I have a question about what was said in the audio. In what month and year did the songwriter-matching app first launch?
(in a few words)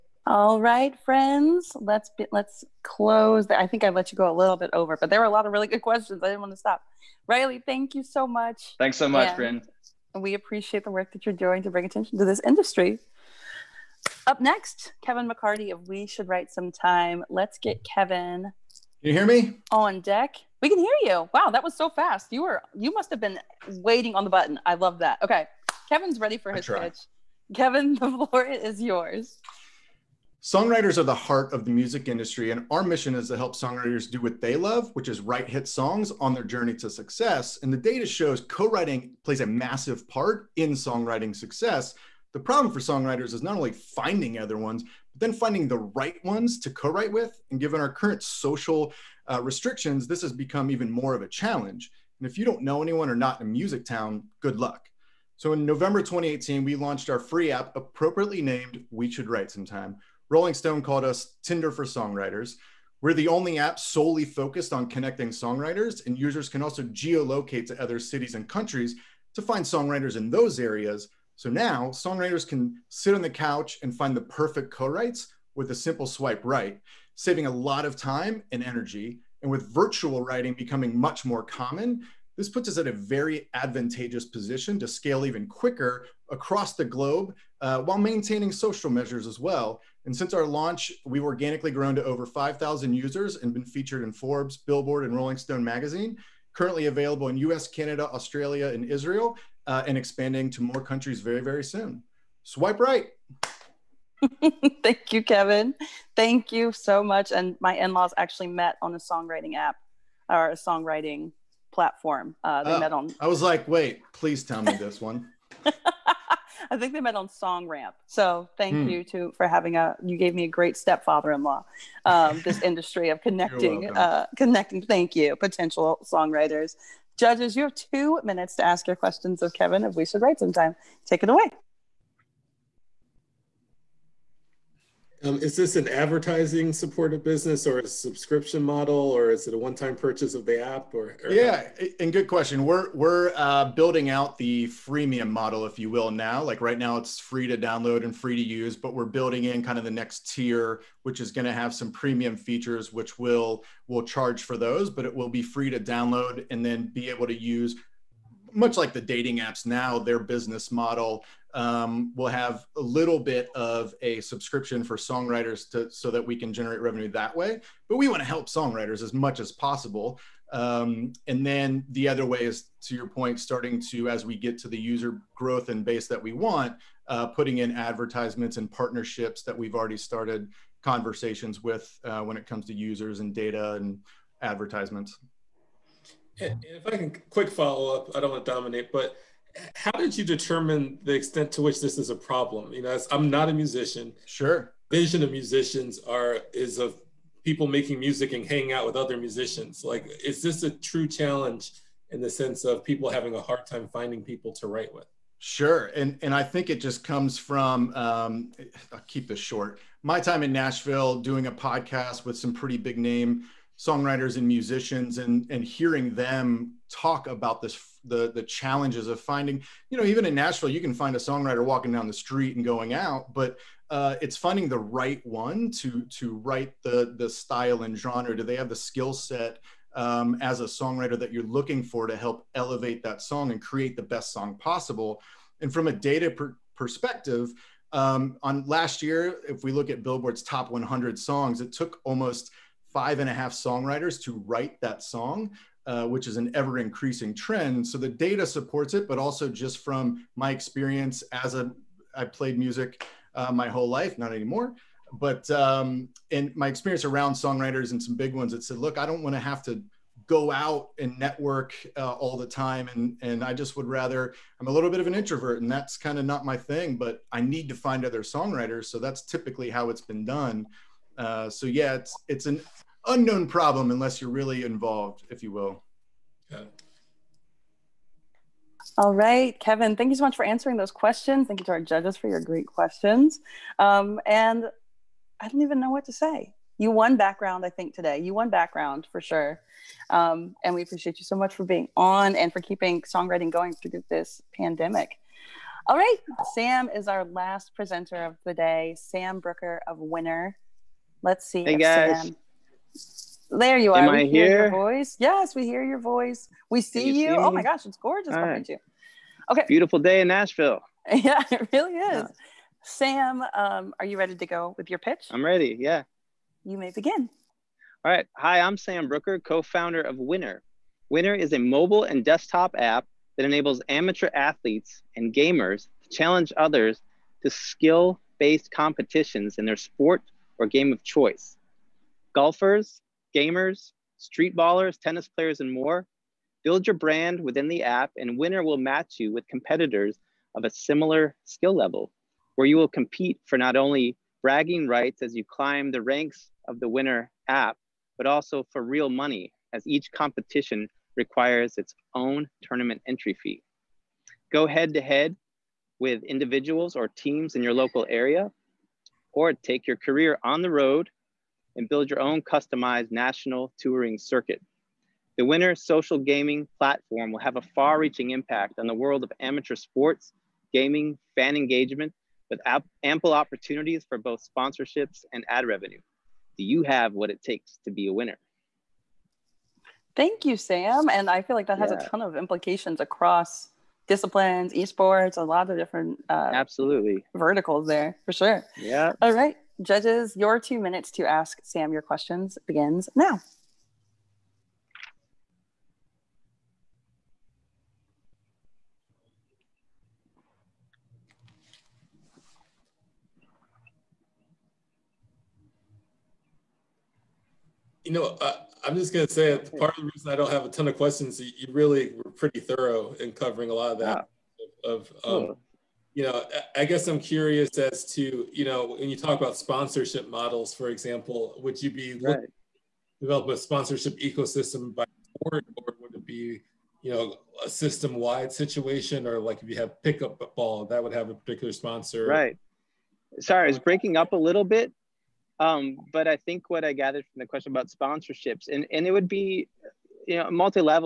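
November 2018.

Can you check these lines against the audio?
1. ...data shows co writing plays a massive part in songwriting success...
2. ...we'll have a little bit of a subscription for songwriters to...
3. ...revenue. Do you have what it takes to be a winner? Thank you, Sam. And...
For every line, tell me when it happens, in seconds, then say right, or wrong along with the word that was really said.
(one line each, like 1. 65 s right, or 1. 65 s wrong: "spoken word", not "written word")
1. 37 s right
2. 162 s right
3. 375 s right.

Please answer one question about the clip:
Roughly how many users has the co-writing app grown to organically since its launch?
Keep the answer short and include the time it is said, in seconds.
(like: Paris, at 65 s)
5,000, at 92 s.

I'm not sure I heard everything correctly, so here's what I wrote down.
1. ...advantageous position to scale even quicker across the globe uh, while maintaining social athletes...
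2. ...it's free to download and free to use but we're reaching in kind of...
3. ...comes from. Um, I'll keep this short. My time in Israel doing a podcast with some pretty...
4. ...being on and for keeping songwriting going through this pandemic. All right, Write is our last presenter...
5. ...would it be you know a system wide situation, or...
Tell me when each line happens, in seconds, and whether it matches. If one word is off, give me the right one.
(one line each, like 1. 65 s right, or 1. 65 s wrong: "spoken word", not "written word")
1. 83 s wrong: "measures", not "athletes"
2. 146 s wrong: "building", not "reaching"
3. 207 s wrong: "Nashville", not "Israel"
4. 291 s wrong: "Sam", not "Write"
5. 426 s right.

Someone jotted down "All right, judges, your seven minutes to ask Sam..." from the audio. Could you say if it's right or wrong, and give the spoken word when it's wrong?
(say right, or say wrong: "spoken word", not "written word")
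wrong: "two", not "seven".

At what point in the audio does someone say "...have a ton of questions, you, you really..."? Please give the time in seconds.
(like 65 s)
410 s.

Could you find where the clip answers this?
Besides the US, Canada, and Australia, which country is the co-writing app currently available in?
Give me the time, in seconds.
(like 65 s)
98 s.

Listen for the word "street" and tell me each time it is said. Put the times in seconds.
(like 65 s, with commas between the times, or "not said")
222 s, 334 s.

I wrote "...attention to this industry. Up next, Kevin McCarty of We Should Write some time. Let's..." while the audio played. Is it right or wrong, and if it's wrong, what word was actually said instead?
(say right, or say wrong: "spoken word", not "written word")
right.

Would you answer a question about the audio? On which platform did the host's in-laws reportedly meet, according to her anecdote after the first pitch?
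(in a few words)
Song Ramp.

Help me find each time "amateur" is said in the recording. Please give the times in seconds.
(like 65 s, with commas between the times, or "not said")
323 s, 369 s.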